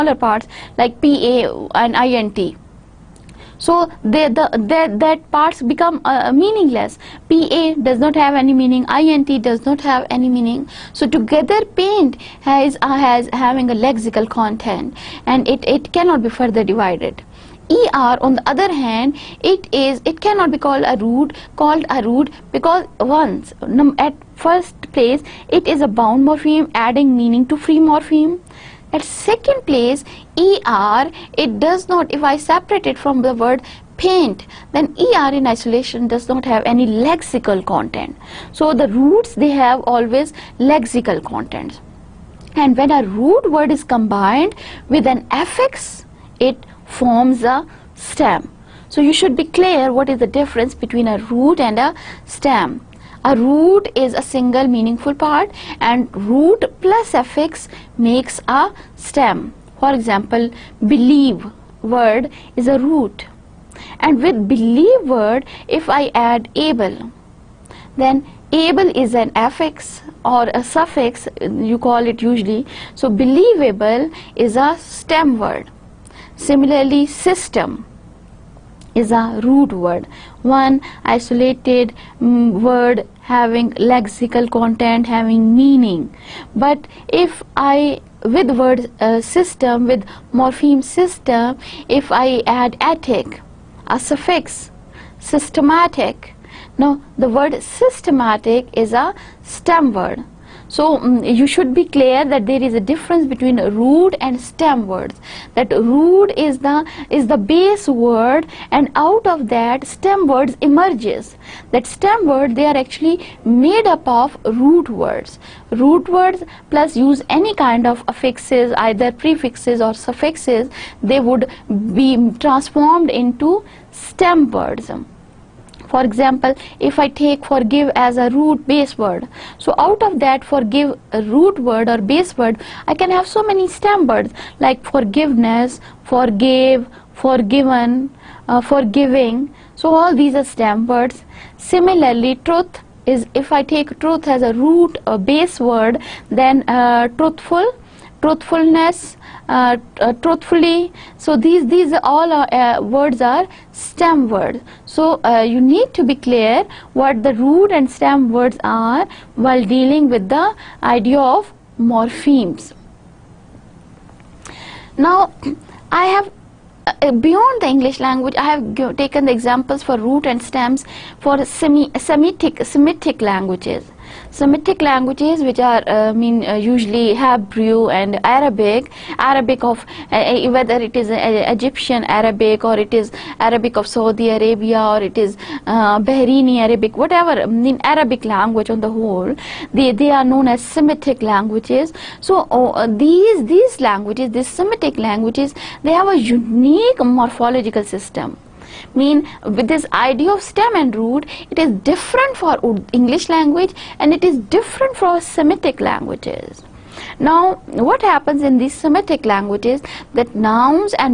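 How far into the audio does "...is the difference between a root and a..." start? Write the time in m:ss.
0:50.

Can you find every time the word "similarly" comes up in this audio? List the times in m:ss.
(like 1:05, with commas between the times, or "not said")
1:16, 2:21.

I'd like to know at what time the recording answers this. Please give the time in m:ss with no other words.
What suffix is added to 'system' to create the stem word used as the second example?
1:32.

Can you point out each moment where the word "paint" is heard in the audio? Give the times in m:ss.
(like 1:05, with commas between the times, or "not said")
0:11, 0:33.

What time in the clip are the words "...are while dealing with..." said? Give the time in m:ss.
2:38.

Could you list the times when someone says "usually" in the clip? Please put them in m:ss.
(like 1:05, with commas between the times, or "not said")
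1:12, 2:56.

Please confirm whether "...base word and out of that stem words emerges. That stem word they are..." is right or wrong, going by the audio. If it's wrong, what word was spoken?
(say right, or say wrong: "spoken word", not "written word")
right.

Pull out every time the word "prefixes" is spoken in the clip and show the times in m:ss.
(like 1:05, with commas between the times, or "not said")
1:59.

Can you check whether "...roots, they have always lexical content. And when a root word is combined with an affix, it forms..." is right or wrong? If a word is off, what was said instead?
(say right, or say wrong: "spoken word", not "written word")
right.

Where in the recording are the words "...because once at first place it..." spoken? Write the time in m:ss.
0:22.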